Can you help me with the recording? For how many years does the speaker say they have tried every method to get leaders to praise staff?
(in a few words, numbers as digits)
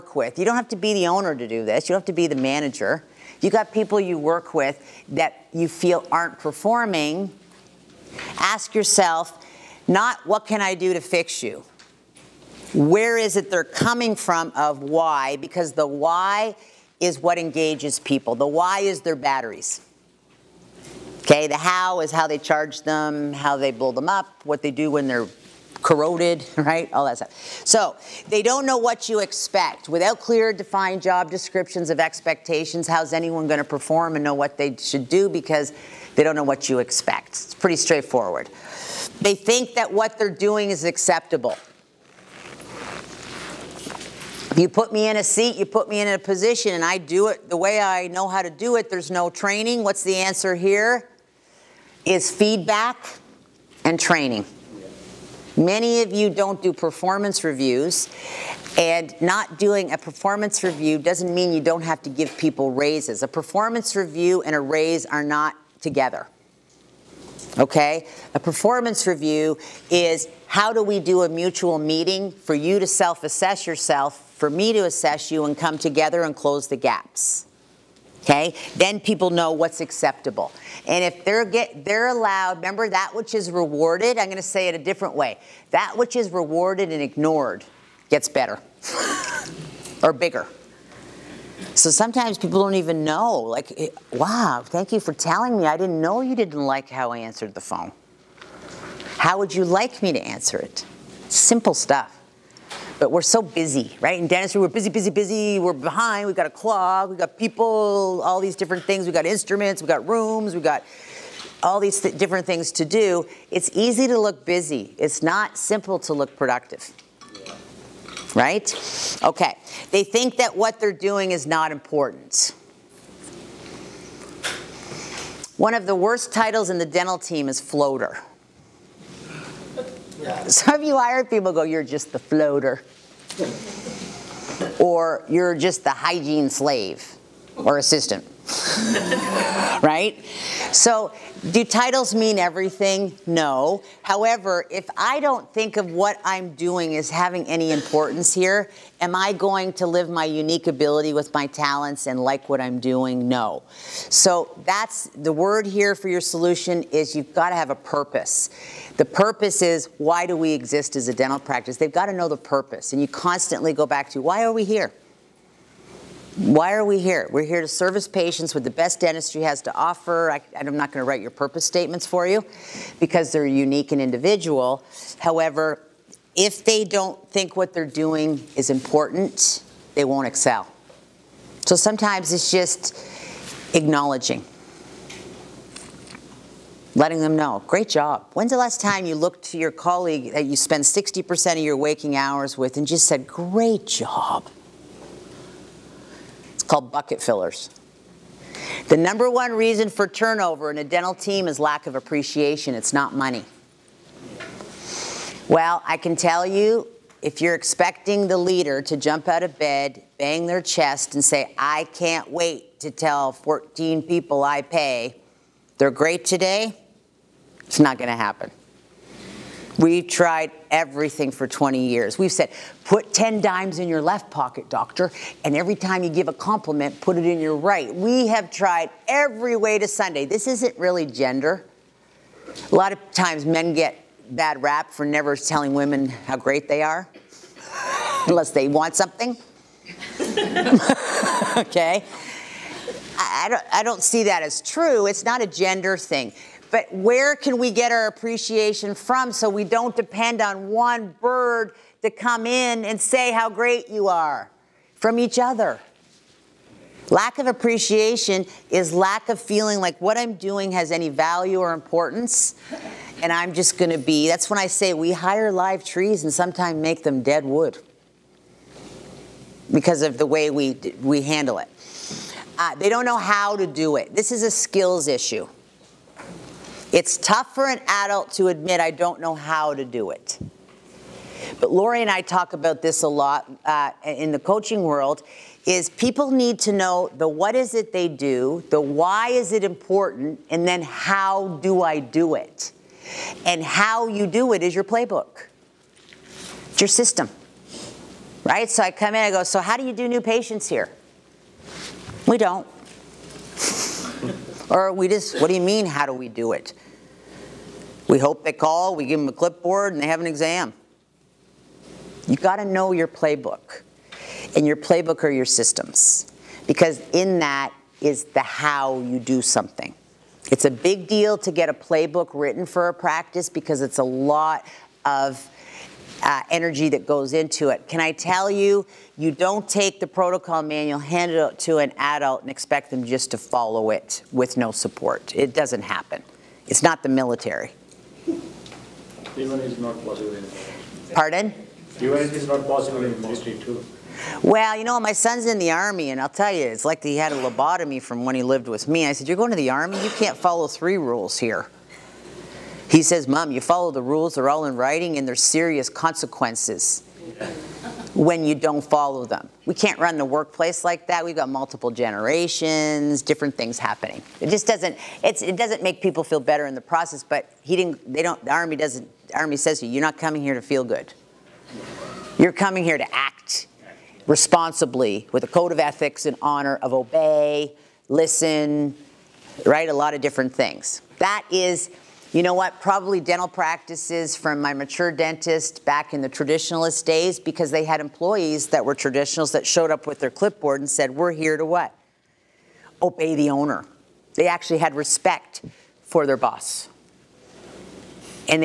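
20 years.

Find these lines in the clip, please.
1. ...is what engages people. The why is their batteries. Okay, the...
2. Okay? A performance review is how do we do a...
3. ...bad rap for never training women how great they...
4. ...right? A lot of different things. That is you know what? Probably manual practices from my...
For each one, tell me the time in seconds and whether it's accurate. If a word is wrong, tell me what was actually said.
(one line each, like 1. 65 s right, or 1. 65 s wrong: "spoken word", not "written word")
1. 16 s right
2. 67 s right
3. 234 s wrong: "telling", not "training"
4. 379 s wrong: "dental", not "manual".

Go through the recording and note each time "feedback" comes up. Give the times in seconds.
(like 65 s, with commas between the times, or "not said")
52 s.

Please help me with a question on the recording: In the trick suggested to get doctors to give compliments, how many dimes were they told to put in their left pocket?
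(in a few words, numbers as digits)
10.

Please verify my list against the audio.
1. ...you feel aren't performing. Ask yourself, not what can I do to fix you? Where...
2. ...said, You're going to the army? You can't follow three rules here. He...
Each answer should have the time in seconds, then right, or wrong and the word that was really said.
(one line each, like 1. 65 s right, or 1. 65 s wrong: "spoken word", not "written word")
1. 5 s right
2. 349 s right.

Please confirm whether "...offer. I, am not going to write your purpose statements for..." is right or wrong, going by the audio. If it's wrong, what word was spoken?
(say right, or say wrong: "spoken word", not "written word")
right.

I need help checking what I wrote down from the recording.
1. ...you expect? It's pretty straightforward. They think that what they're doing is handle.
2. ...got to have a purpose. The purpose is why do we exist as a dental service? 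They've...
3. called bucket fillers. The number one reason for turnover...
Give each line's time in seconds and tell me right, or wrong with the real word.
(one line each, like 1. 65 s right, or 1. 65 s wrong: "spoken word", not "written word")
1. 36 s wrong: "acceptable", not "handle"
2. 157 s wrong: "practice", not "service"
3. 196 s right.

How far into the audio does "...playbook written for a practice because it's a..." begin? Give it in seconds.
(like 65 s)
321 s.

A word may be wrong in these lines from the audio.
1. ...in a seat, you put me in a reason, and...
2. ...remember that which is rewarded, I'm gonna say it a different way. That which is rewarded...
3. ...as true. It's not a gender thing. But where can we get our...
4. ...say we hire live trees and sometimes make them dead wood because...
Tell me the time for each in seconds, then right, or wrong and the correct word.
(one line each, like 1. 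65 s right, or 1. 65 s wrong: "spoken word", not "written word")
1. 45 s wrong: "position", not "reason"
2. 82 s right
3. 244 s right
4. 264 s right.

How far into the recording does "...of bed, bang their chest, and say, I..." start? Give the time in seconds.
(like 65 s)
209 s.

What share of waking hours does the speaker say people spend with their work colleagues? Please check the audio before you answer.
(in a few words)
60%.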